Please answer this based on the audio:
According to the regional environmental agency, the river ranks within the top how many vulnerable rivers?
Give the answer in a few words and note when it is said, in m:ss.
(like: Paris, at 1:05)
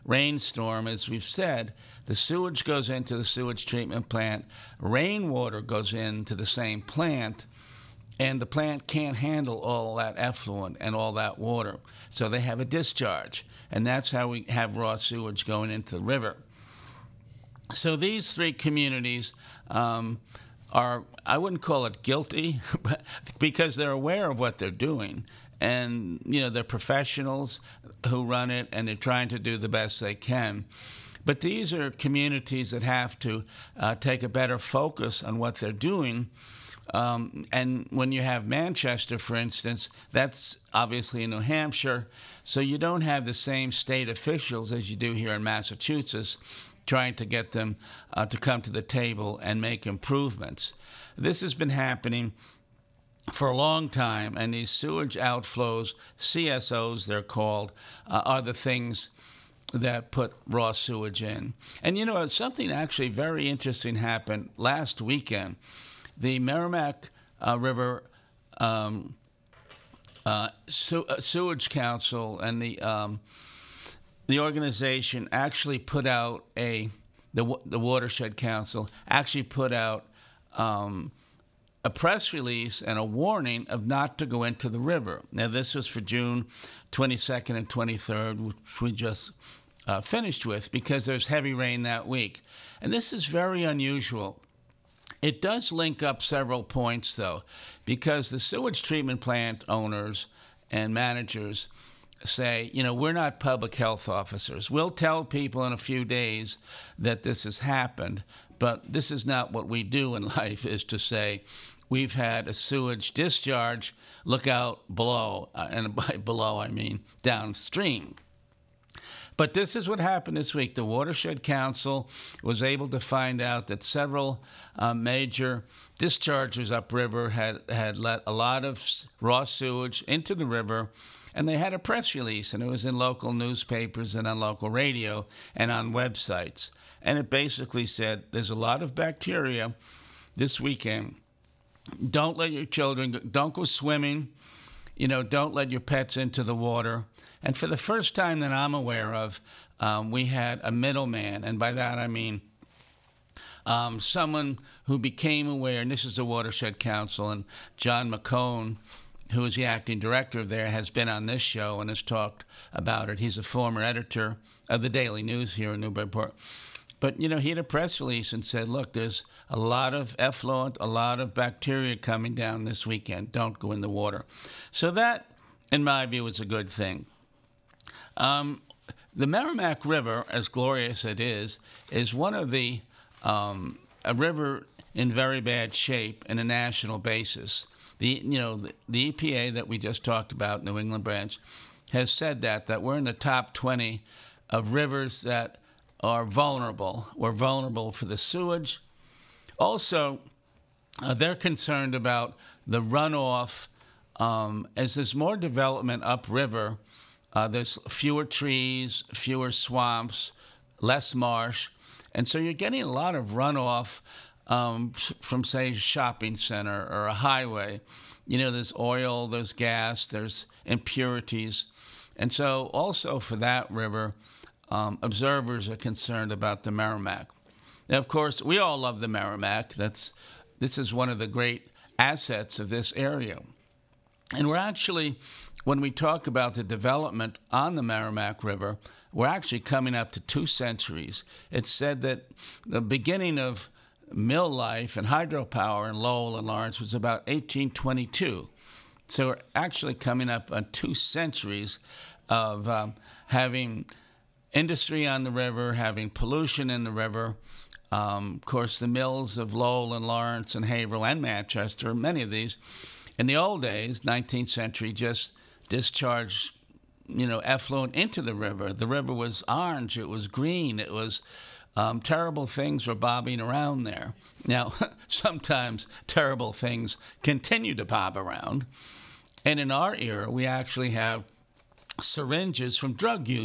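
20, at 3:13.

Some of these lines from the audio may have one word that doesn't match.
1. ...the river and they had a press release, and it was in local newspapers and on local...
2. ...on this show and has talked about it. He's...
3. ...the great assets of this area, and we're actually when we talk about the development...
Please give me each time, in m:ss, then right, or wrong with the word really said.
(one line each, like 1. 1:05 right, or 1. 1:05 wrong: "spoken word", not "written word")
1. 2:10 right
2. 2:41 right
3. 3:51 right.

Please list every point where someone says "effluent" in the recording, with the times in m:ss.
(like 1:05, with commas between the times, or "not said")
0:10, 2:50, 4:27.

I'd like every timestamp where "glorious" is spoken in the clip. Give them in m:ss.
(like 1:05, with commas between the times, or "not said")
3:00.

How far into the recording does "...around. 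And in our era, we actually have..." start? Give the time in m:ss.
4:38.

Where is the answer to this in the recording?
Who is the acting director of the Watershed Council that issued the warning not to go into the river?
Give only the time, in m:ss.
2:37.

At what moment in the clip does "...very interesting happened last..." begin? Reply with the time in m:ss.
1:03.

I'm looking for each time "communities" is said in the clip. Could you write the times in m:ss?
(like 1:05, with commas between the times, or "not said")
0:18, 0:31.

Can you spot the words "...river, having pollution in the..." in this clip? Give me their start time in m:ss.
4:15.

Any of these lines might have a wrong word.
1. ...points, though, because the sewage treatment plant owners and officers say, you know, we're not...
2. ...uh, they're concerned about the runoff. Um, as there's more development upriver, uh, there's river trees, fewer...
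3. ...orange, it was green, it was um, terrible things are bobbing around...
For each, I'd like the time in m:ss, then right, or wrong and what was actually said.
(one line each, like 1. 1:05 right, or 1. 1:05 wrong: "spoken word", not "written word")
1. 1:36 wrong: "managers", not "officers"
2. 3:21 wrong: "fewer", not "river"
3. 4:29 right.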